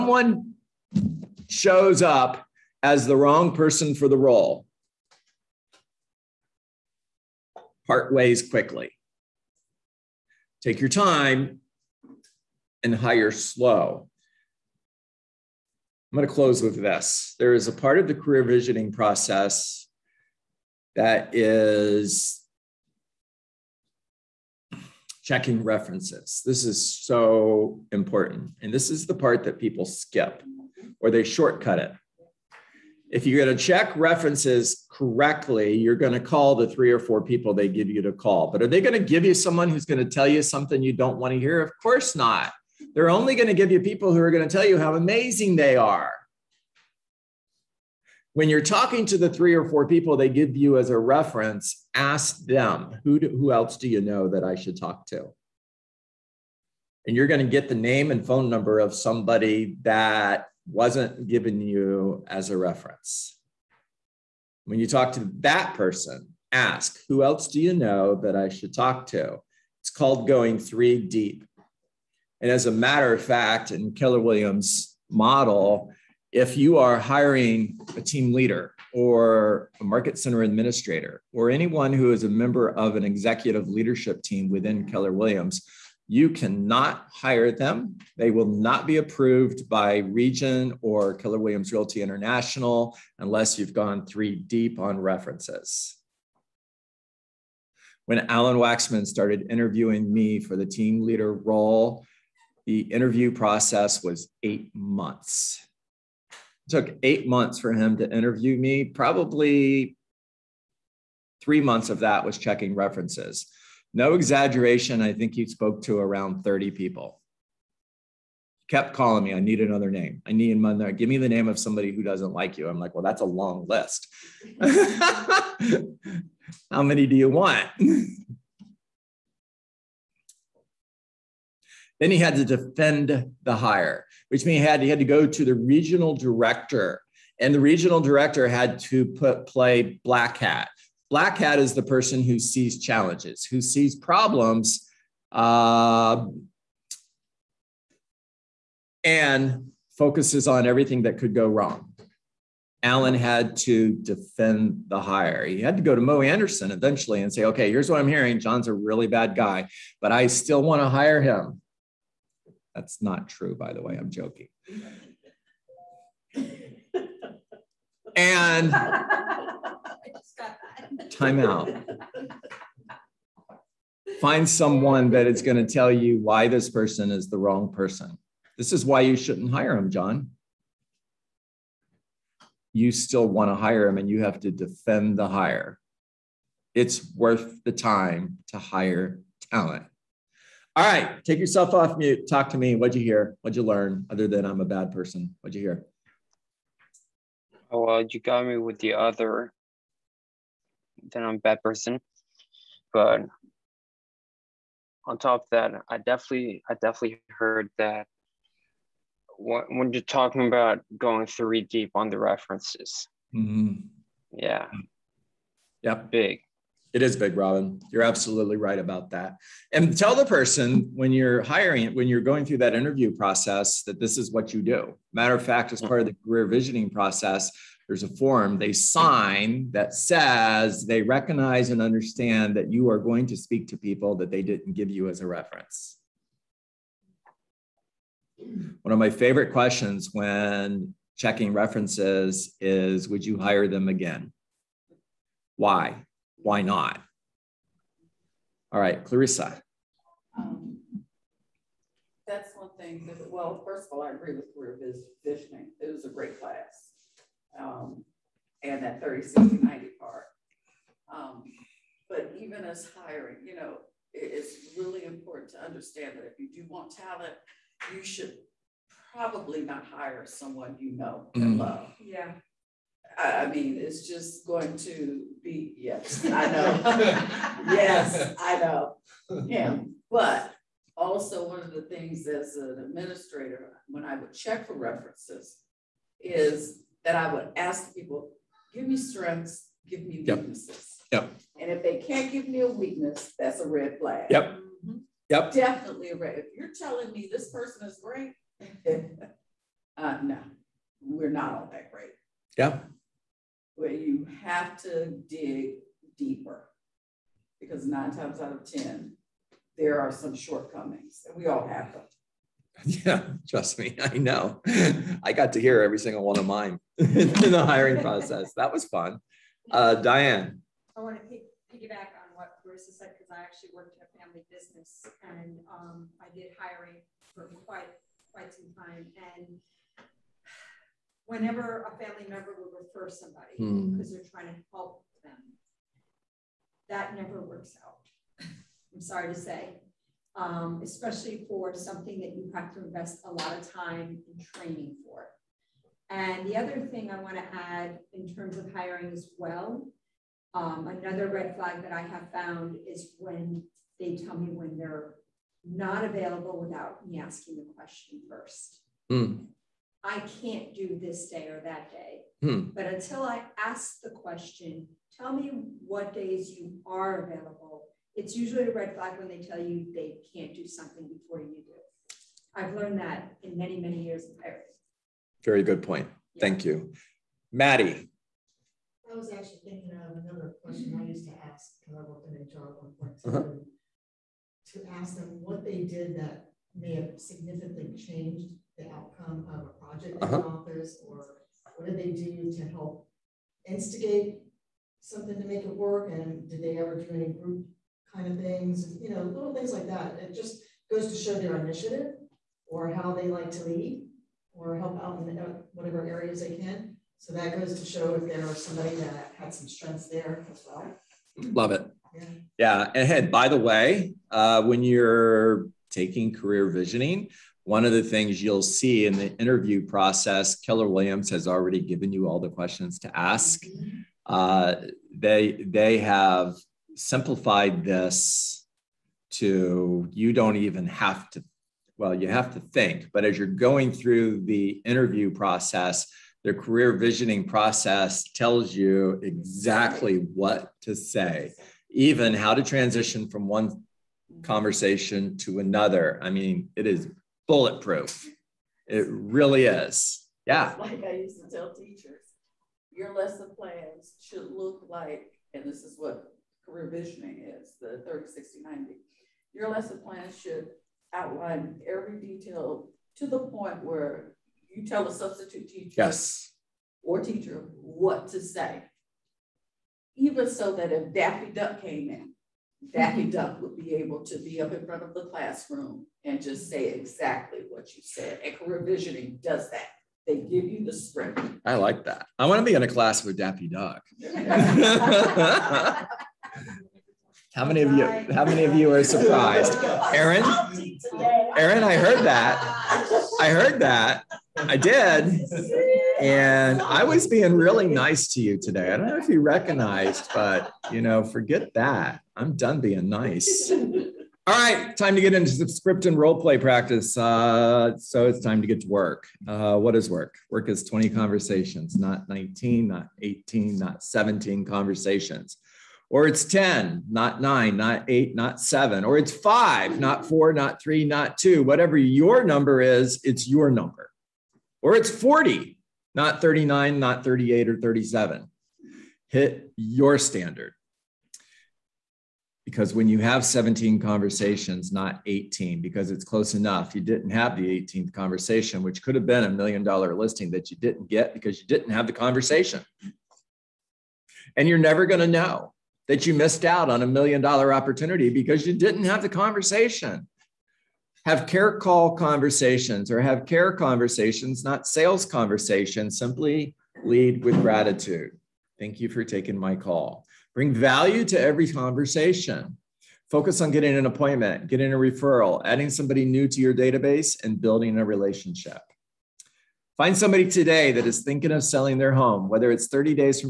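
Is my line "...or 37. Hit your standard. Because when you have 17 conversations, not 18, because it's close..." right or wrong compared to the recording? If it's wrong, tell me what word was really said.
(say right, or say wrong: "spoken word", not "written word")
right.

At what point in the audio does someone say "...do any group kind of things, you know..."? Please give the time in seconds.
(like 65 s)
397 s.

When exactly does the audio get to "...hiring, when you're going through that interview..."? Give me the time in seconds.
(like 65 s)
221 s.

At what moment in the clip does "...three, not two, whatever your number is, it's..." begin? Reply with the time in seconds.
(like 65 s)
520 s.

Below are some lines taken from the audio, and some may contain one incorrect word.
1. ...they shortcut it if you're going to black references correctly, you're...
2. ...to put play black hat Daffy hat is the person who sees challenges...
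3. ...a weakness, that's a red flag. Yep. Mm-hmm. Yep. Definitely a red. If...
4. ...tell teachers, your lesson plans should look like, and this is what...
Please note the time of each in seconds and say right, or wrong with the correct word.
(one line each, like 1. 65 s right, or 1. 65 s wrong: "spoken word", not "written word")
1. 31 s wrong: "check", not "black"
2. 138 s wrong: "Black", not "Daffy"
3. 292 s right
4. 451 s right.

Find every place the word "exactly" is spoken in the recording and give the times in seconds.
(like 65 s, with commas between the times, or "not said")
439 s, 476 s.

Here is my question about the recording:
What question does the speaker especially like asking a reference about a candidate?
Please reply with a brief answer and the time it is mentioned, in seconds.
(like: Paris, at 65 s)
Would you hire them again?, at 243 s.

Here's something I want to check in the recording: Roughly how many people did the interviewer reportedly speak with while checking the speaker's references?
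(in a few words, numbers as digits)
30.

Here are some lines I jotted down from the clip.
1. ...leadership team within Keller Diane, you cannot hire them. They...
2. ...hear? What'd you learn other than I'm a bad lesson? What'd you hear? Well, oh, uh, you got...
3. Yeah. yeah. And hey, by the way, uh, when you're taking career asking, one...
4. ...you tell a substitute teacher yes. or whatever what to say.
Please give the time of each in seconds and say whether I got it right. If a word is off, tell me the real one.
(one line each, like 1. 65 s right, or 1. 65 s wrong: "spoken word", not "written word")
1. 83 s wrong: "Williams", not "Diane"
2. 193 s wrong: "person", not "lesson"
3. 412 s wrong: "visioning", not "asking"
4. 464 s wrong: "teacher", not "whatever".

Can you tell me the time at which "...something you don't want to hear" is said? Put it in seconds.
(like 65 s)
40 s.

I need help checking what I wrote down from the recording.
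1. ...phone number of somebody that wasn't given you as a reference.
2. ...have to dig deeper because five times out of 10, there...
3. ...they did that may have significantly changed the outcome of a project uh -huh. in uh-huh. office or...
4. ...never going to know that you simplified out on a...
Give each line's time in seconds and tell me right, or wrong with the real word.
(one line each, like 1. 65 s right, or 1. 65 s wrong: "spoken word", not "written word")
1. 58 s right
2. 304 s wrong: "nine", not "five"
3. 385 s right
4. 544 s wrong: "missed", not "simplified".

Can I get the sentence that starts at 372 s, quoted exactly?
I've learned that in many, many years of hiring.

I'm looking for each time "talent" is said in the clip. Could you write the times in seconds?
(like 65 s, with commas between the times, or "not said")
189 s, 266 s.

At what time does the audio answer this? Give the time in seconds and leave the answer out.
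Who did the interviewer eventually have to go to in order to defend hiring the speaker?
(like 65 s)
155 s.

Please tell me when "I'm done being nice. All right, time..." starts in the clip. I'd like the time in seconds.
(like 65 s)
502 s.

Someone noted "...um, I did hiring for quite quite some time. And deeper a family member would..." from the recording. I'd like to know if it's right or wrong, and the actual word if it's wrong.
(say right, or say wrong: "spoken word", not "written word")
wrong: "whenever", not "deeper".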